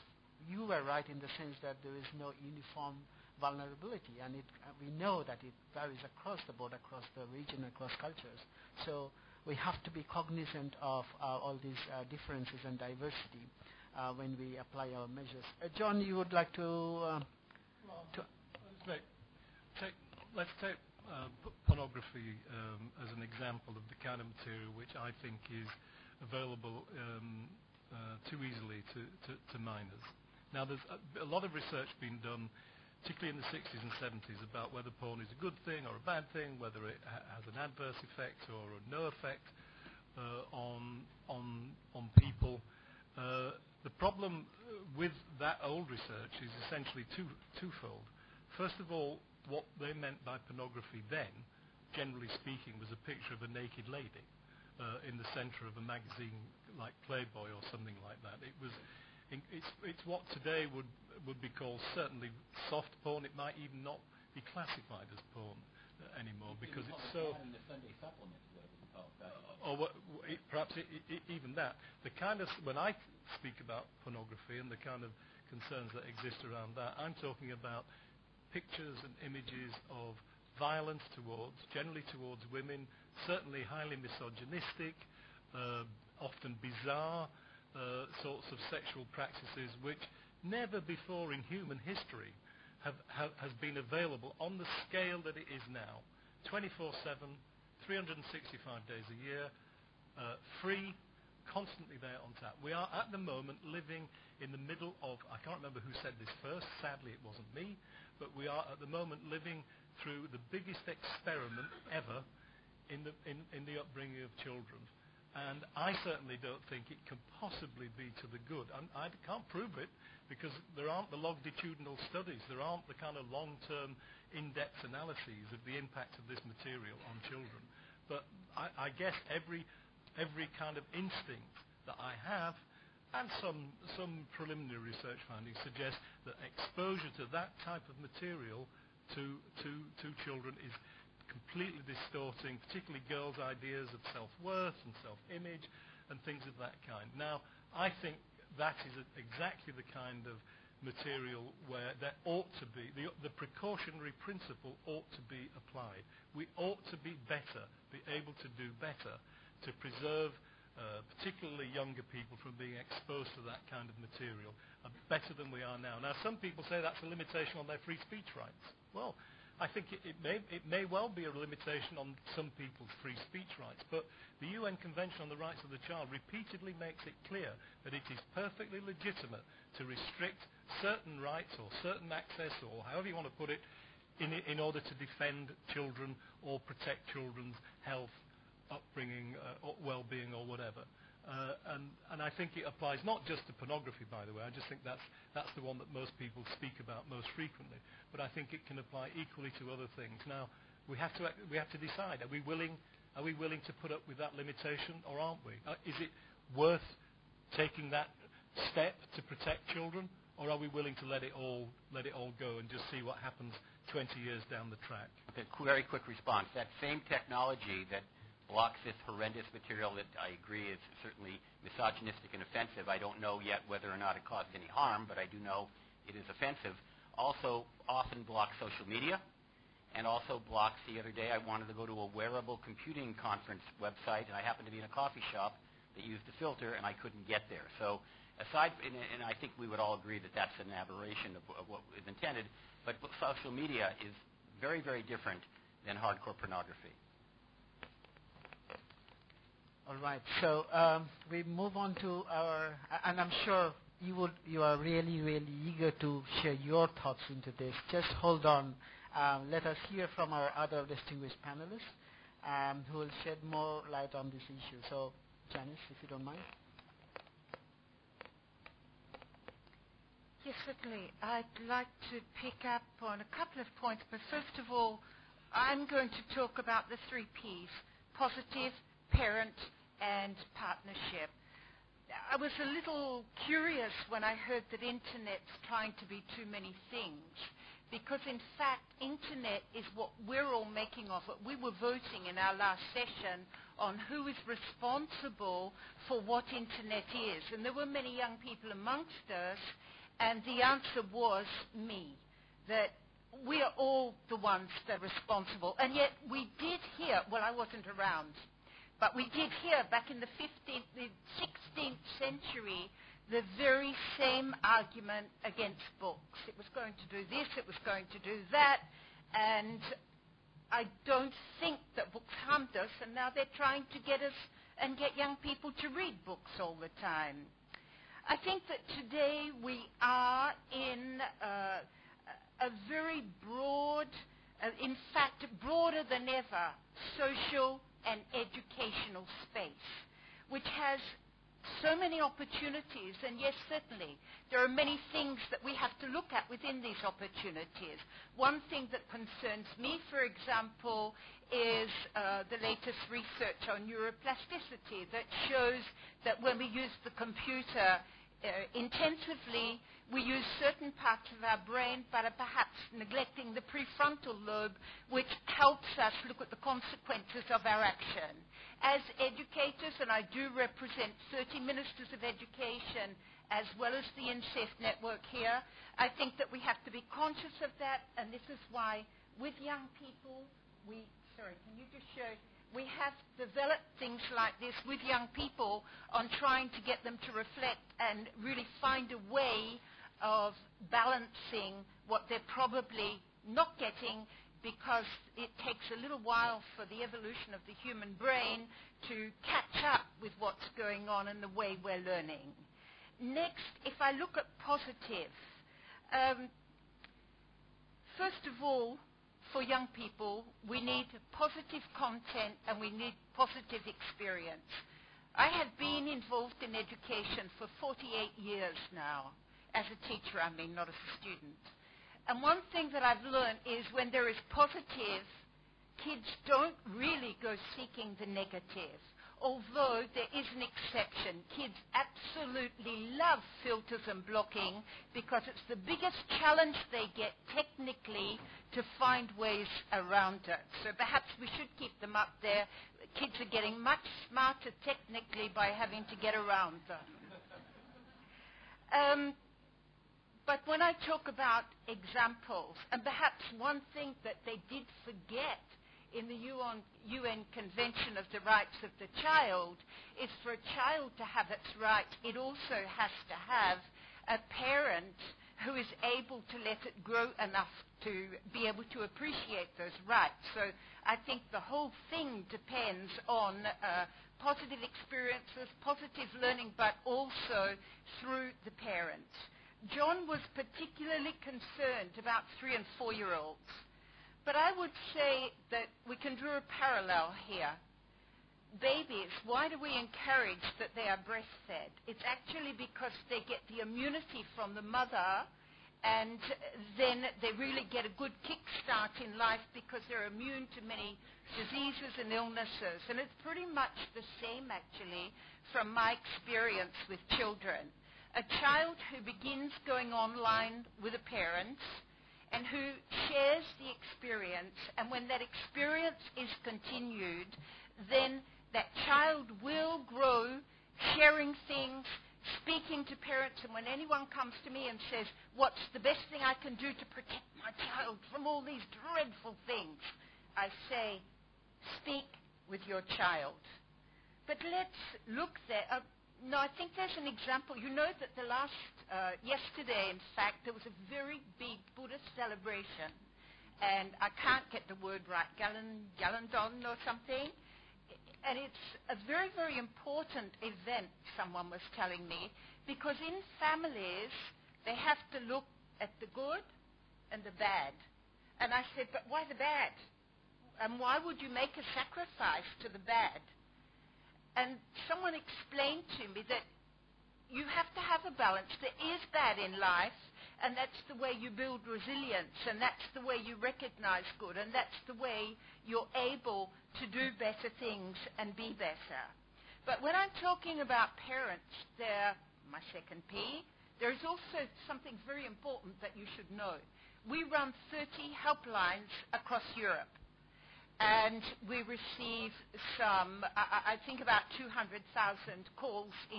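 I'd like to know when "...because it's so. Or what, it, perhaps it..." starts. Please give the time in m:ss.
1:06.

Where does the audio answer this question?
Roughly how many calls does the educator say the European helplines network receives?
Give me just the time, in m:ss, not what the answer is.
9:54.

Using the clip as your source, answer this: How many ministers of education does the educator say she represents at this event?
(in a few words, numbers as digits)
30.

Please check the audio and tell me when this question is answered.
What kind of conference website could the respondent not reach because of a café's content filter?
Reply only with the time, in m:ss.
3:52.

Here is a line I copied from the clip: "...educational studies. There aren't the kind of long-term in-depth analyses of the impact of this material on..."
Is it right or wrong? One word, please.
wrong.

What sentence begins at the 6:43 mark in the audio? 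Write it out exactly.
Next, if I look at positive, um, first of all, for young people, we need positive content and we need positive experience.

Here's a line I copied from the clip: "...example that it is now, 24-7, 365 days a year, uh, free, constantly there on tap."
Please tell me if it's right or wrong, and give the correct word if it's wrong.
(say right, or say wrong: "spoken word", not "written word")
wrong: "scale", not "example".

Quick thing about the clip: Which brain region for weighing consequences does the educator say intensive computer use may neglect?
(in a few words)
prefrontal lobe.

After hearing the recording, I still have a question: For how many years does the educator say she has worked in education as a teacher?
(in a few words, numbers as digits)
48.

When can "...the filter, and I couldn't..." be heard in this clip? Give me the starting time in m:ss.
3:56.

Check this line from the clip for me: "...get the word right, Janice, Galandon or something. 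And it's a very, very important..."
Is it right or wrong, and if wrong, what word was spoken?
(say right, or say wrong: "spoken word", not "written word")
wrong: "Galan", not "Janice".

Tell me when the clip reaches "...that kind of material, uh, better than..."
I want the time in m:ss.
2:43.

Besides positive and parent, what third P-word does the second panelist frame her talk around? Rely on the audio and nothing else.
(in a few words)
partnership.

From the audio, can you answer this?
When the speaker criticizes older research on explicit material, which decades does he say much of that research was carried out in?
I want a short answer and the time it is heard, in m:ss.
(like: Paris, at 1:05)
the 60s and 70s, at 0:33.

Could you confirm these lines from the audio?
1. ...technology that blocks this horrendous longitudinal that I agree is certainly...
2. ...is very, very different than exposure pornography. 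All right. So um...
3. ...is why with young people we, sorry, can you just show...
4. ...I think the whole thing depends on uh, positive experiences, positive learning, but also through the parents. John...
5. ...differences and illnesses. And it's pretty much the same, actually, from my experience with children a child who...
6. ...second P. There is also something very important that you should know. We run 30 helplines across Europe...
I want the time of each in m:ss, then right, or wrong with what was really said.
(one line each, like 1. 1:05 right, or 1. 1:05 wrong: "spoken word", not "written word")
1. 3:37 wrong: "material", not "longitudinal"
2. 4:03 wrong: "hardcore", not "exposure"
3. 6:18 right
4. 7:51 right
5. 8:21 wrong: "diseases", not "differences"
6. 9:42 right.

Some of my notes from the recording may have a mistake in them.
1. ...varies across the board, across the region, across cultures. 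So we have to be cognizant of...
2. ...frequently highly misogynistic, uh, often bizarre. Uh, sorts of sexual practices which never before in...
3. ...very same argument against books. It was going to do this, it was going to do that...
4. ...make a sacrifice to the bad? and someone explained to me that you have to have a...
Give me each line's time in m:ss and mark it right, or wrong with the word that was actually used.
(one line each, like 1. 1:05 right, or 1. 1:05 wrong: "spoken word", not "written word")
1. 0:05 right
2. 1:23 wrong: "certainly", not "frequently"
3. 5:13 right
4. 9:21 right.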